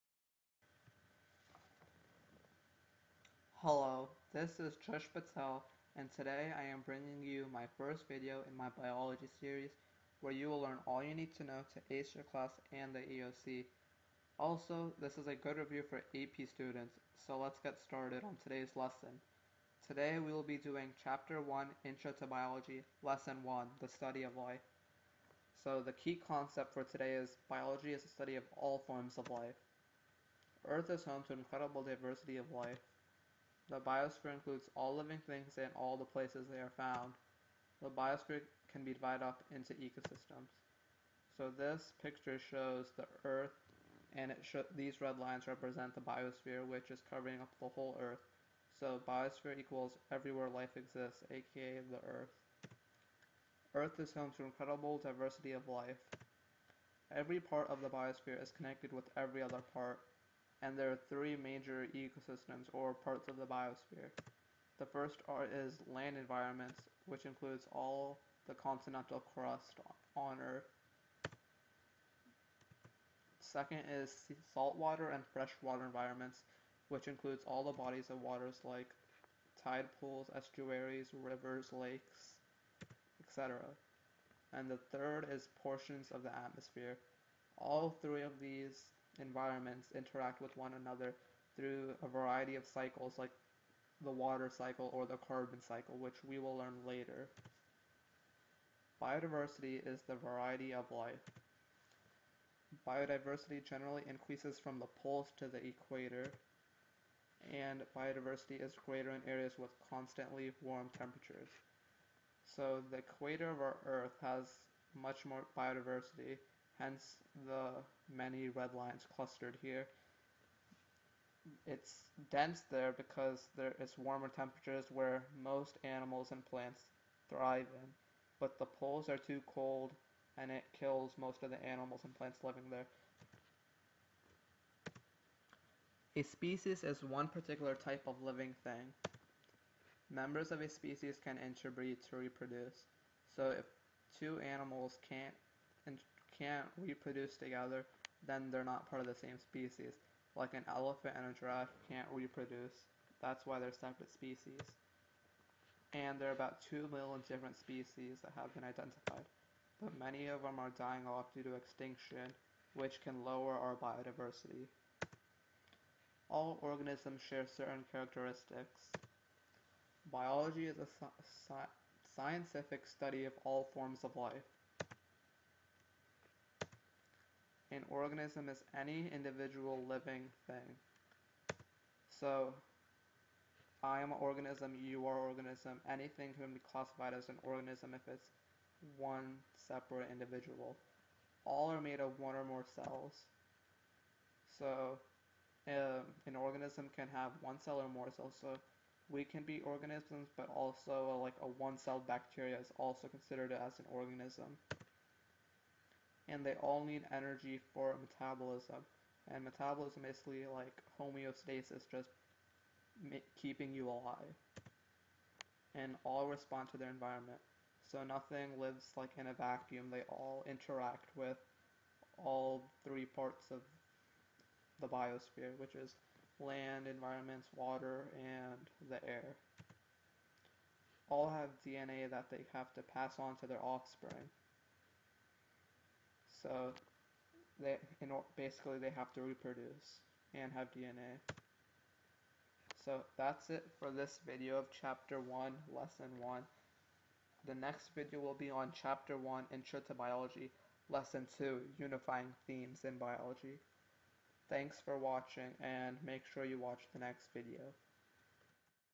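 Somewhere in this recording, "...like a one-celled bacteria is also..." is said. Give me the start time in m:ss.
3:21.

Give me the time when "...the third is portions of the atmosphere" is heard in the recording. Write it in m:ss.
1:24.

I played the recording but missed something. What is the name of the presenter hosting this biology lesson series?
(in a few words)
Trish Patel.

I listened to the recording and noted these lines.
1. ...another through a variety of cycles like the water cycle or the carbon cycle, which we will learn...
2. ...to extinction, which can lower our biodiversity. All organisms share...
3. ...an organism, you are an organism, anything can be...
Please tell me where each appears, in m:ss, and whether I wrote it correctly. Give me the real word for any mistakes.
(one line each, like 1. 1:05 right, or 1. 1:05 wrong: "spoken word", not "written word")
1. 1:30 right
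2. 2:41 right
3. 3:04 right.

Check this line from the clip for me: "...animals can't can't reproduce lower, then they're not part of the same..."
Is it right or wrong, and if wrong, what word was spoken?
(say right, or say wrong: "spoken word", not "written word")
wrong: "together", not "lower".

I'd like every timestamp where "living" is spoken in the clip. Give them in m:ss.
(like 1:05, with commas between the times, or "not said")
0:34, 2:12, 2:18, 2:59.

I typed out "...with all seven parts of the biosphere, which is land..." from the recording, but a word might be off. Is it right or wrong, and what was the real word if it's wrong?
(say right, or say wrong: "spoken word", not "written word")
wrong: "three", not "seven".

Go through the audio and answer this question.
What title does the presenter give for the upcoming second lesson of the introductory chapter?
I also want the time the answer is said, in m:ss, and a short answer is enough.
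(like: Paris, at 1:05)
Unifying Themes in Biology, at 4:11.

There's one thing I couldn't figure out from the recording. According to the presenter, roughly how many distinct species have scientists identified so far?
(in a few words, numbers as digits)
2 million.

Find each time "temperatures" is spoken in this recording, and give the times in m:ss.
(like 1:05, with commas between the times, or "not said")
1:50, 2:04.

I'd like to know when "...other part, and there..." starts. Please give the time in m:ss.
0:59.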